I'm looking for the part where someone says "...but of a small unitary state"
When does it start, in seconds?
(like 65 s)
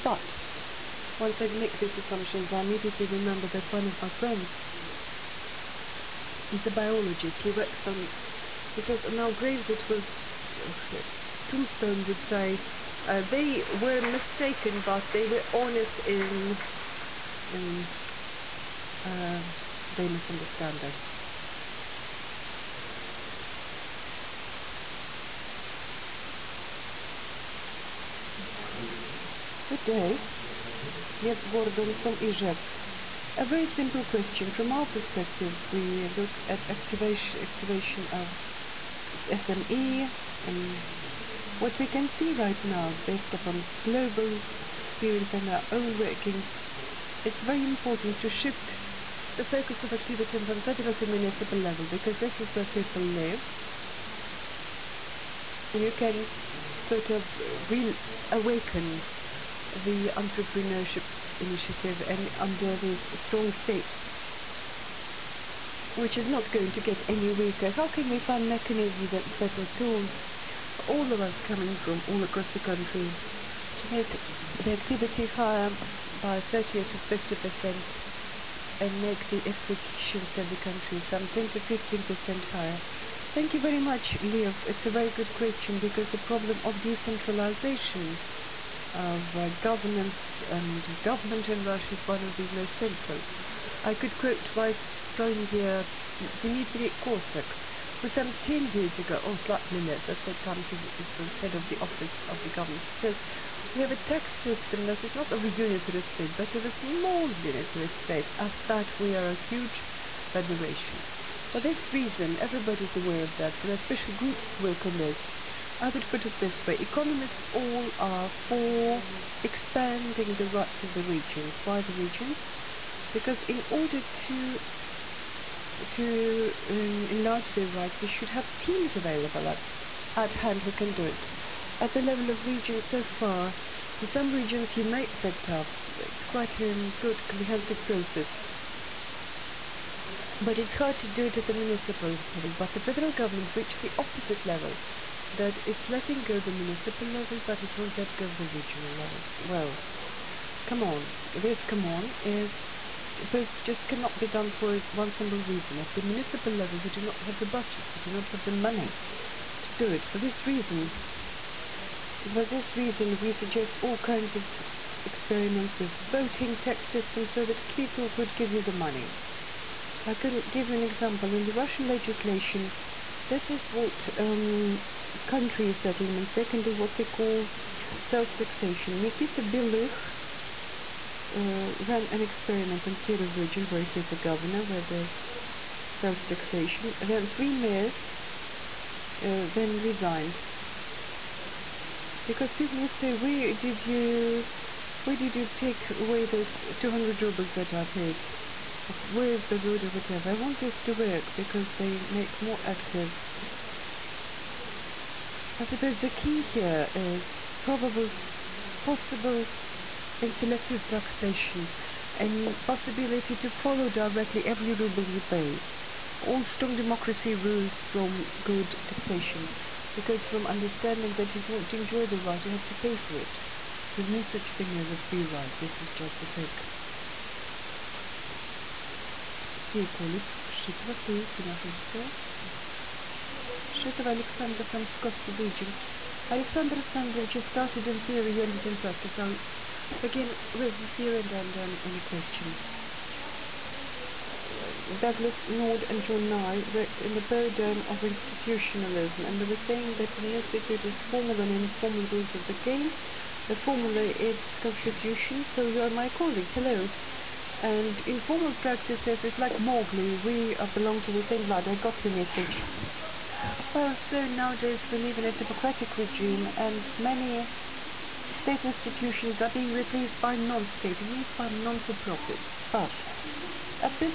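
106 s.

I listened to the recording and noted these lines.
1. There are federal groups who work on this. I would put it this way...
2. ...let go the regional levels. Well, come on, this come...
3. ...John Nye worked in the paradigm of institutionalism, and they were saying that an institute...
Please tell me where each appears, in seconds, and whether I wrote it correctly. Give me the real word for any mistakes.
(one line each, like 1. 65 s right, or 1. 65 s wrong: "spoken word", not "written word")
1. 113 s wrong: "special", not "federal"
2. 147 s right
3. 246 s right.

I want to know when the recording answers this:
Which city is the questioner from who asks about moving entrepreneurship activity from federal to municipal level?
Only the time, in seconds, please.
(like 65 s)
32 s.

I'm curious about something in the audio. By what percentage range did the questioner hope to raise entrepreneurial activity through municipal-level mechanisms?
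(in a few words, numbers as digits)
30 to 50 percent.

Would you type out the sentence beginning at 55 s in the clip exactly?
You can sort of reawaken the entrepreneurship initiative and under this strong state which is not going to get any weaker.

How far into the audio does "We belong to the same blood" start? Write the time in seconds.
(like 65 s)
260 s.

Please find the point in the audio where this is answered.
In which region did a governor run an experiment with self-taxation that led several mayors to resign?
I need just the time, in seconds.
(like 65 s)
182 s.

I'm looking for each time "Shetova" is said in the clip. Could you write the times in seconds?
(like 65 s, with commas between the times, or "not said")
233 s.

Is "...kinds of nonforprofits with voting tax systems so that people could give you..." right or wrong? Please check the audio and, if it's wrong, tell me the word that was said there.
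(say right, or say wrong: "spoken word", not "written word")
wrong: "experiments", not "nonforprofits".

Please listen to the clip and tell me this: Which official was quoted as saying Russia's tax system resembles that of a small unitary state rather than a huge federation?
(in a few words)
Dmitry Kozak.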